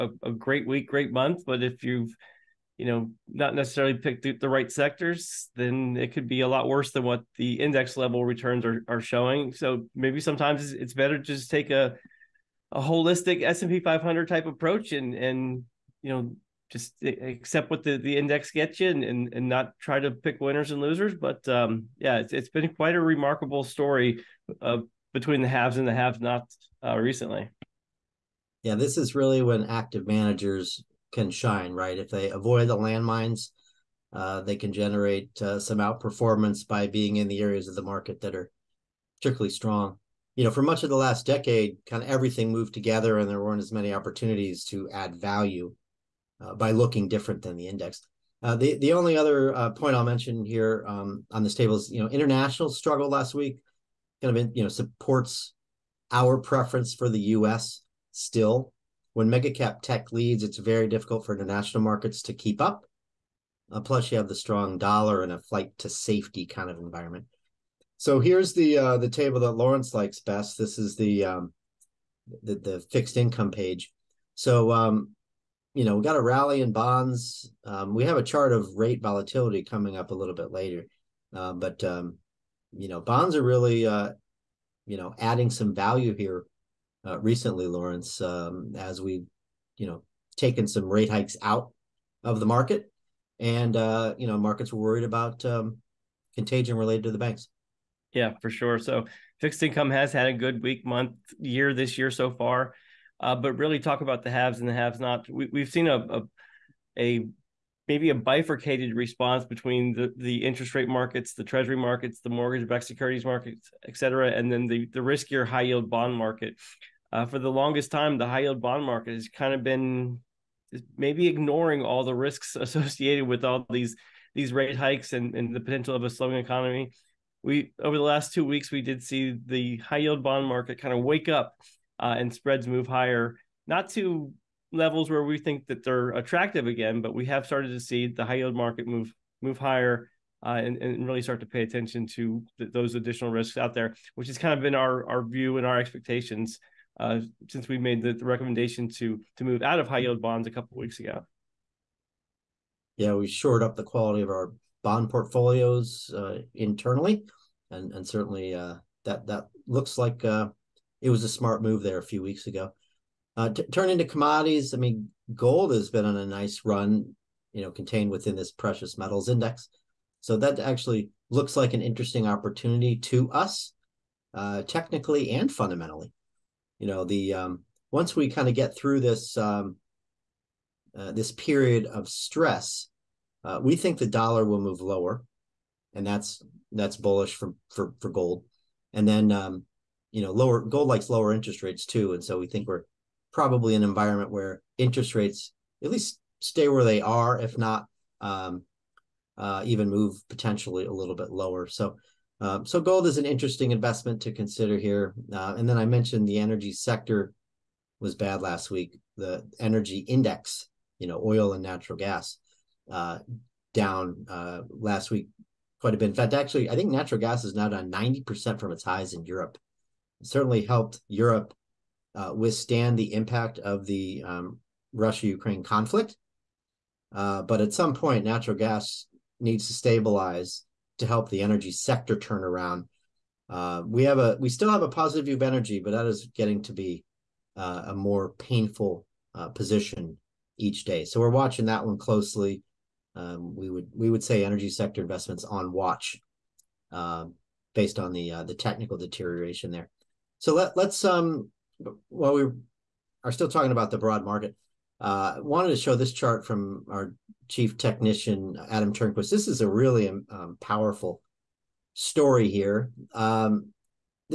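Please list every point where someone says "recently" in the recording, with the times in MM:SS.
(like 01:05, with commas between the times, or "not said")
00:26, 01:27.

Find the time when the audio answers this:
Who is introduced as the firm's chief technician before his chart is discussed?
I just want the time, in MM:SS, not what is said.
04:18.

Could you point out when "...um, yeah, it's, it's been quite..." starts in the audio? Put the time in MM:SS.
00:21.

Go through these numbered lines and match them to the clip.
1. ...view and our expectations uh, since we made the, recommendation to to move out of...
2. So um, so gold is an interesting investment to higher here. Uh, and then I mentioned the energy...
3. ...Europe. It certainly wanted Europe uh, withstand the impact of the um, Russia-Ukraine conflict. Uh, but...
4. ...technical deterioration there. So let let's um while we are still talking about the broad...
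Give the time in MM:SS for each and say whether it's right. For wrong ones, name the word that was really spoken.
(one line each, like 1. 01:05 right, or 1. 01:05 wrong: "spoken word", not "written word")
1. 02:25 right
2. 03:21 wrong: "consider", not "higher"
3. 03:39 wrong: "helped", not "wanted"
4. 04:08 right.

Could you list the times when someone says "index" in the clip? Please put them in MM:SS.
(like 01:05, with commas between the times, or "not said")
00:07, 00:18, 00:47, 02:49, 03:29.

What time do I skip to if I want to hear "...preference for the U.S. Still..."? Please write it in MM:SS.
00:56.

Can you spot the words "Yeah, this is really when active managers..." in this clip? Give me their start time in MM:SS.
00:28.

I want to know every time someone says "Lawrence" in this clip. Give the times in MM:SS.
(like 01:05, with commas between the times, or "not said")
01:09, 01:27.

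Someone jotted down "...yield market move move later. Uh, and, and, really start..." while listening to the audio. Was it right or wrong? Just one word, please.
wrong.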